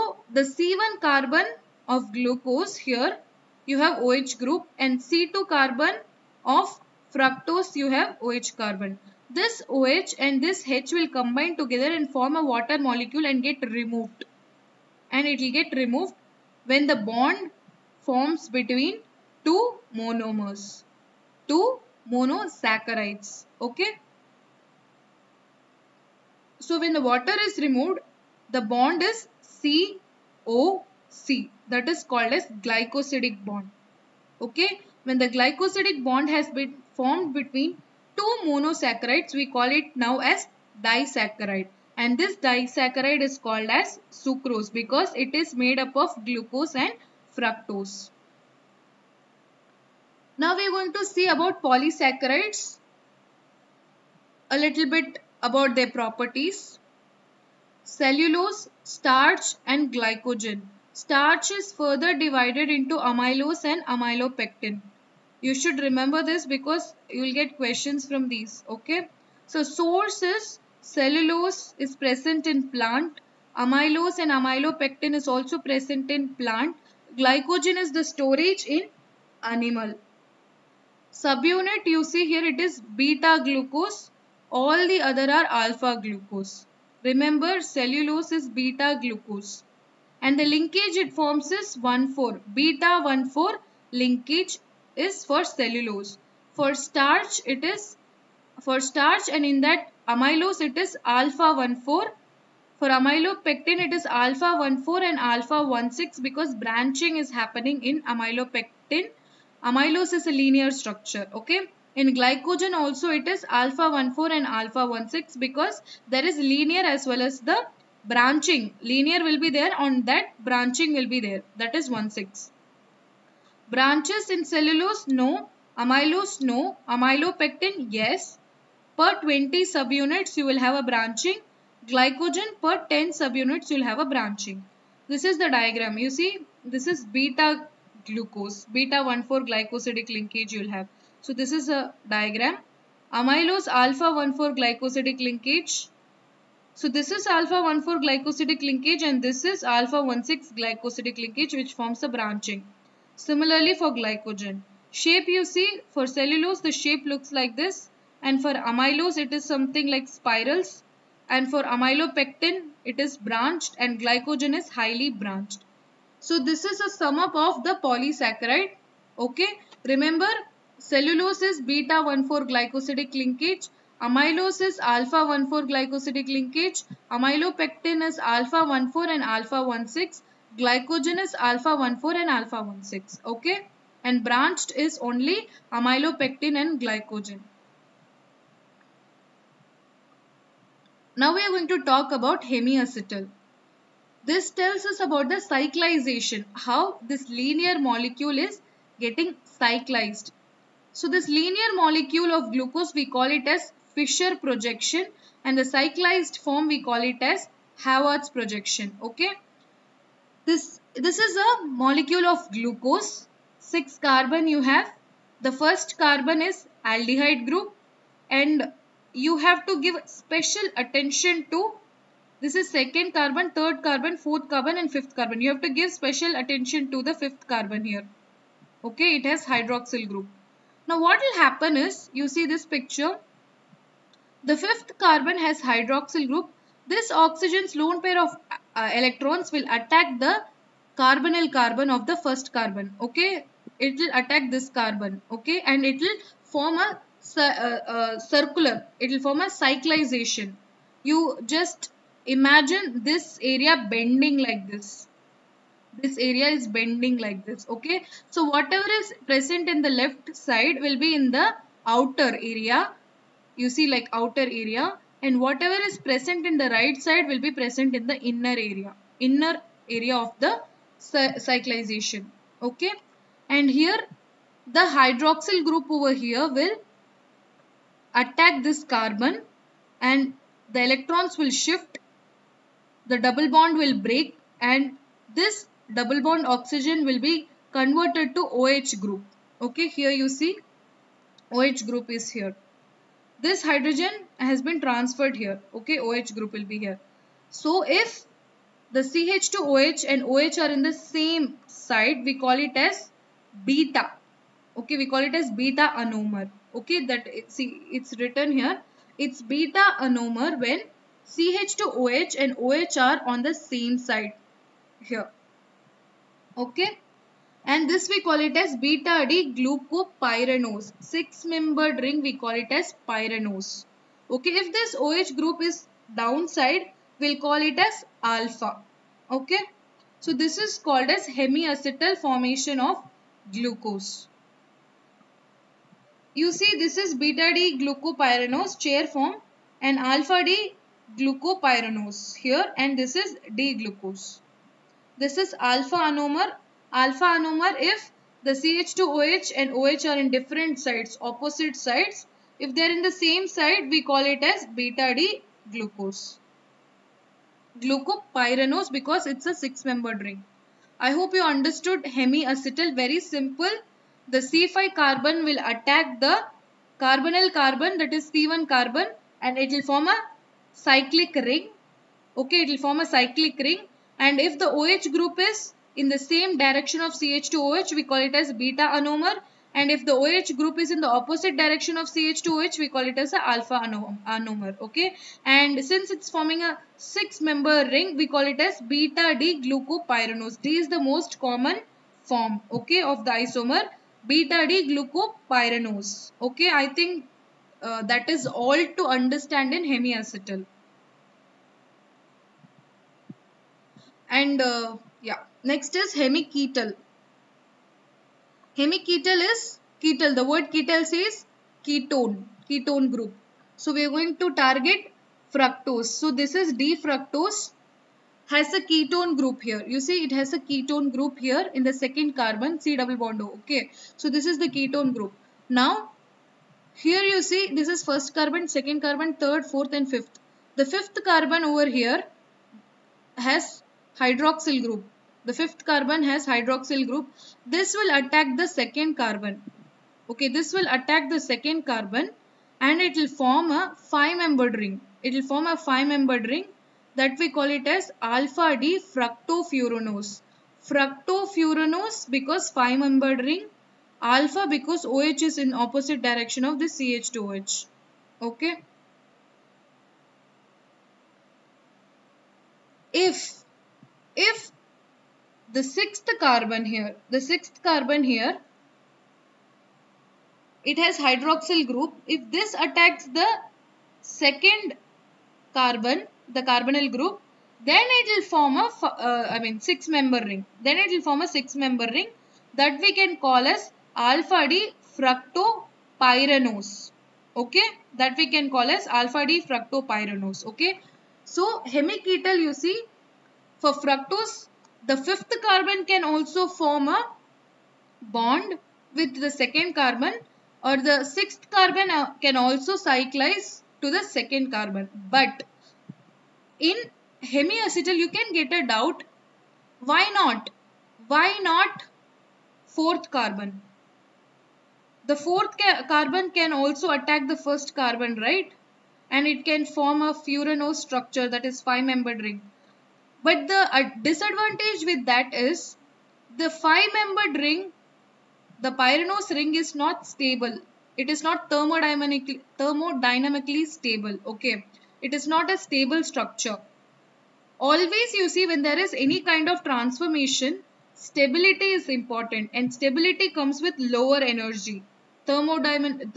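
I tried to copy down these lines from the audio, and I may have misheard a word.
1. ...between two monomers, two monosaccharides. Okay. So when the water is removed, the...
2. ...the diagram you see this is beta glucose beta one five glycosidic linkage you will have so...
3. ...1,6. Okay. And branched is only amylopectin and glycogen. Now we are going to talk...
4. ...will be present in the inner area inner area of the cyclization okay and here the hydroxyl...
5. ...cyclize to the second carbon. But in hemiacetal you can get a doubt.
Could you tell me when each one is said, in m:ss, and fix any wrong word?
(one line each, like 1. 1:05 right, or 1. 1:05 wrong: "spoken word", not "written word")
1. 0:18 right
2. 2:15 wrong: "four", not "five"
3. 3:02 right
4. 4:27 right
5. 8:22 right.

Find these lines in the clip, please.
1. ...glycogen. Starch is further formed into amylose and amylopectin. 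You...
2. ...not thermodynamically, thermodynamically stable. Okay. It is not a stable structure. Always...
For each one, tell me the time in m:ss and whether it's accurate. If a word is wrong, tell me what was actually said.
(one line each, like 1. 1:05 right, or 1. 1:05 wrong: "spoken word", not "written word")
1. 0:59 wrong: "divided", not "formed"
2. 8:51 right.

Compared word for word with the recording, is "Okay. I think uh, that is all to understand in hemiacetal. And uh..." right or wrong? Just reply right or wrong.
right.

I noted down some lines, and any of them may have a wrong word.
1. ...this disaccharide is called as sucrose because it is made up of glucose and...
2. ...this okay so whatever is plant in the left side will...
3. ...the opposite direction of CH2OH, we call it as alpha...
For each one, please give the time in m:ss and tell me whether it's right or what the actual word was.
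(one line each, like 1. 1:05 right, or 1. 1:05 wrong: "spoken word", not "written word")
1. 0:42 right
2. 4:17 wrong: "present", not "plant"
3. 6:21 right.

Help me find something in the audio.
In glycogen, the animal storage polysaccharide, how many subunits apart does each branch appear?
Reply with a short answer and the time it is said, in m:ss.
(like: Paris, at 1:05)
10, at 2:11.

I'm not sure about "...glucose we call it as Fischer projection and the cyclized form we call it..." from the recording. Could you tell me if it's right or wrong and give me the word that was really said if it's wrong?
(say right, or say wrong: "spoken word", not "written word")
right.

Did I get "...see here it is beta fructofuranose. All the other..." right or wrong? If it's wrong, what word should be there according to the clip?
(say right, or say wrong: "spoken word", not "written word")
wrong: "glucose", not "fructofuranose".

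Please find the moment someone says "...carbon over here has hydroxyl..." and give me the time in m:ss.
7:11.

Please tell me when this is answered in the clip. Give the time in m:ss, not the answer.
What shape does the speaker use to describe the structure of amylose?
2:39.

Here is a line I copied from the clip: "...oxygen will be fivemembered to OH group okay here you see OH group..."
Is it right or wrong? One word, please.
wrong.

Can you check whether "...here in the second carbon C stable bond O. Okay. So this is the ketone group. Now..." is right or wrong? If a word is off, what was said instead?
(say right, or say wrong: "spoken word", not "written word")
wrong: "double", not "stable".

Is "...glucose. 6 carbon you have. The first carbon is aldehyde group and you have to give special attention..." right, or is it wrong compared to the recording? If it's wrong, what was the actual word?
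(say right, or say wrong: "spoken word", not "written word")
right.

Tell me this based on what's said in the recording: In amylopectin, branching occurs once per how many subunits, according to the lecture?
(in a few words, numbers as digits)
20.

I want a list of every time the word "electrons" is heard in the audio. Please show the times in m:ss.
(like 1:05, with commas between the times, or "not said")
3:58, 4:40.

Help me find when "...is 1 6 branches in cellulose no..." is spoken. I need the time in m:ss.
2:01.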